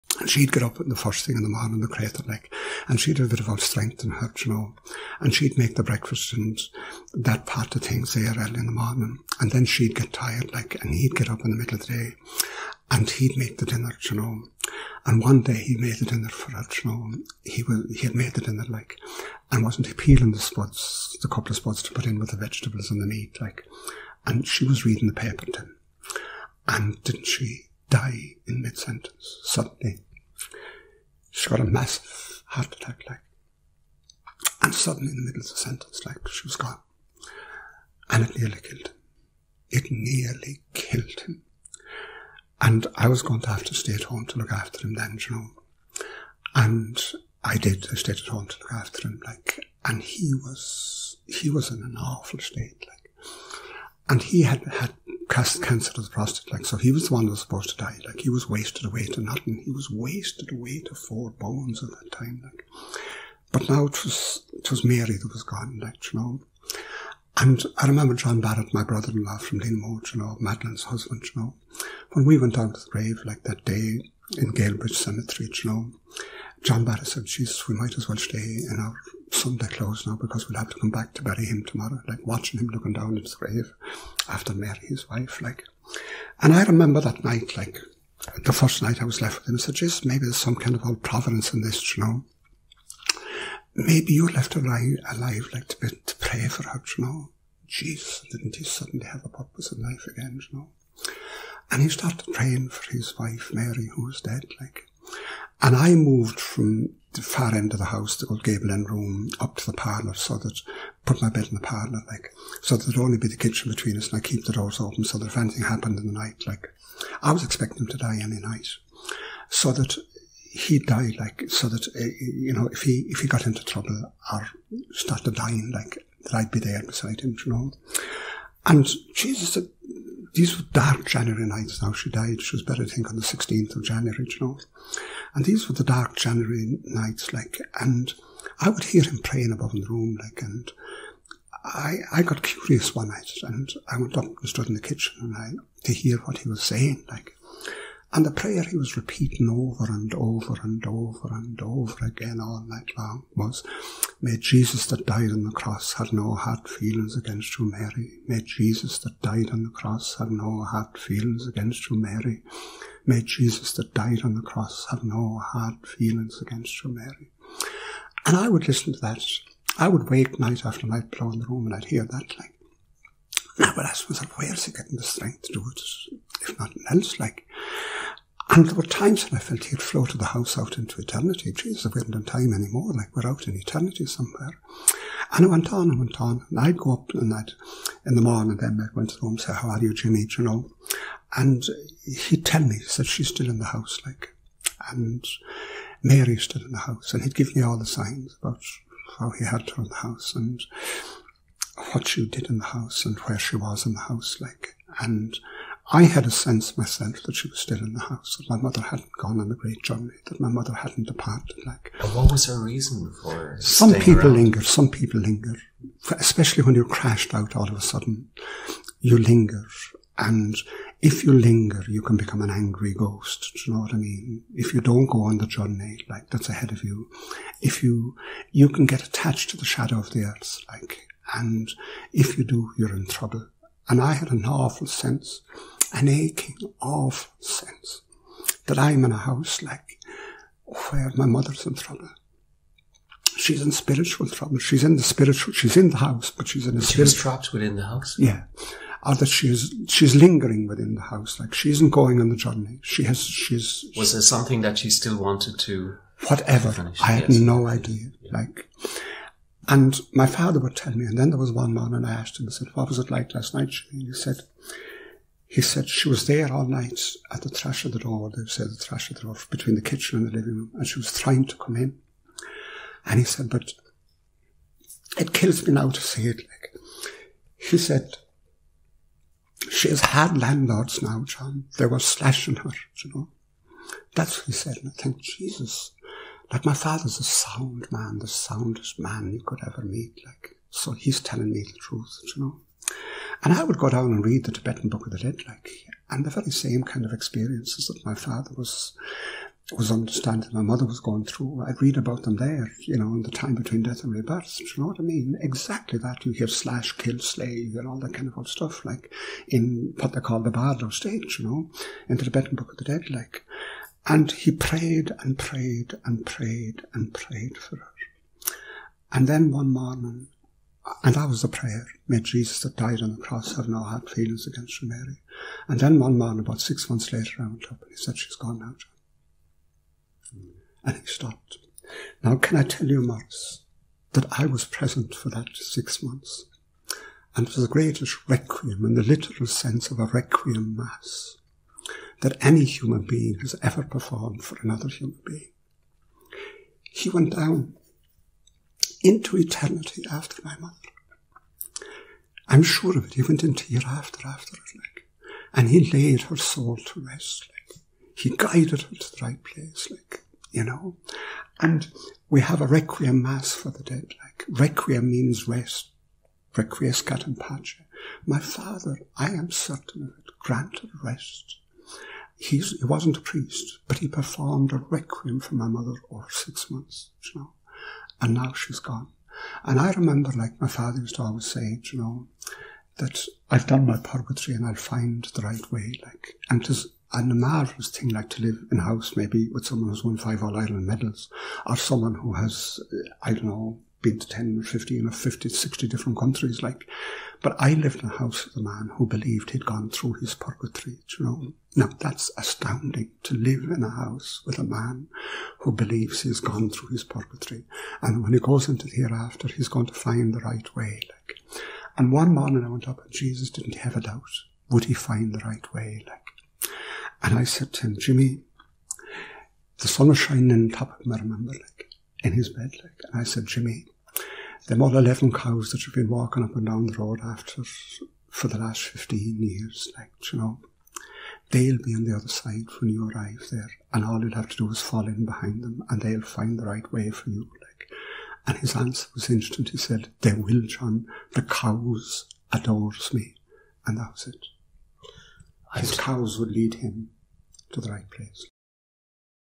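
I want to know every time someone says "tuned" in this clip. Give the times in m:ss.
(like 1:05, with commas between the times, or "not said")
not said.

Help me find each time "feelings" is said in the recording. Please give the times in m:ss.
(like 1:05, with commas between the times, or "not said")
2:36, 2:40, 2:45, 5:24.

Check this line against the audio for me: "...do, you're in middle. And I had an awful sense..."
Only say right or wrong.
wrong.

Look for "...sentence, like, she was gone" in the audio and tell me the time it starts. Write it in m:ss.
0:35.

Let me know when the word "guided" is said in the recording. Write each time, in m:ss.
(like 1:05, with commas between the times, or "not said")
5:58.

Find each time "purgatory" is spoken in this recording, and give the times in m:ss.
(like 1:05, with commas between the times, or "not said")
6:23, 6:40, 6:47.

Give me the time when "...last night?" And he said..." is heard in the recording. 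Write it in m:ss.
4:23.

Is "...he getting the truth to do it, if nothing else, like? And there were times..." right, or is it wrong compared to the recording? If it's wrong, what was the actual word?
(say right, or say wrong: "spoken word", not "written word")
wrong: "strength", not "truth".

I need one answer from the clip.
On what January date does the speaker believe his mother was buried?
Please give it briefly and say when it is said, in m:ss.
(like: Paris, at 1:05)
16 January, at 2:13.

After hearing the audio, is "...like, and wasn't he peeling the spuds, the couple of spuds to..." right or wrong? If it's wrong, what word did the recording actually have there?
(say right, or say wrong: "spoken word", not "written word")
right.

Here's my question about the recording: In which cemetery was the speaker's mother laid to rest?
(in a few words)
Galebridge Cemetery.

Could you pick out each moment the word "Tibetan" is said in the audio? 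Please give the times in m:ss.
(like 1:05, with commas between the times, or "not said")
4:54, 5:12.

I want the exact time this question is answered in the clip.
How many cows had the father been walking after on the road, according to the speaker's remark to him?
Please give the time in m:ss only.
7:04.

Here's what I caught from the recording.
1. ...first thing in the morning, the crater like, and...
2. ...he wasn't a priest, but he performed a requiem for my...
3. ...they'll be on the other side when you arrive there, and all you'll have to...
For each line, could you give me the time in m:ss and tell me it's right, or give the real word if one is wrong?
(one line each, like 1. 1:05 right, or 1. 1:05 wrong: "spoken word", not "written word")
1. 0:00 right
2. 6:12 right
3. 7:11 right.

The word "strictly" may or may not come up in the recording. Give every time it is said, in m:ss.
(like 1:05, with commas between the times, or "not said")
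not said.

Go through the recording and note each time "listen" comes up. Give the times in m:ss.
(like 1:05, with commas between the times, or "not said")
2:48.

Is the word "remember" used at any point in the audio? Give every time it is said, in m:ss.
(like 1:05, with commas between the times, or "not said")
1:07, 1:26, 6:19, 7:01.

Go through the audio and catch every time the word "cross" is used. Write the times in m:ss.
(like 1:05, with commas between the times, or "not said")
2:35, 2:39, 2:44, 5:23.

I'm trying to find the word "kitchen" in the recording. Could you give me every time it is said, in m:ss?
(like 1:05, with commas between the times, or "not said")
1:53, 2:24, 4:29.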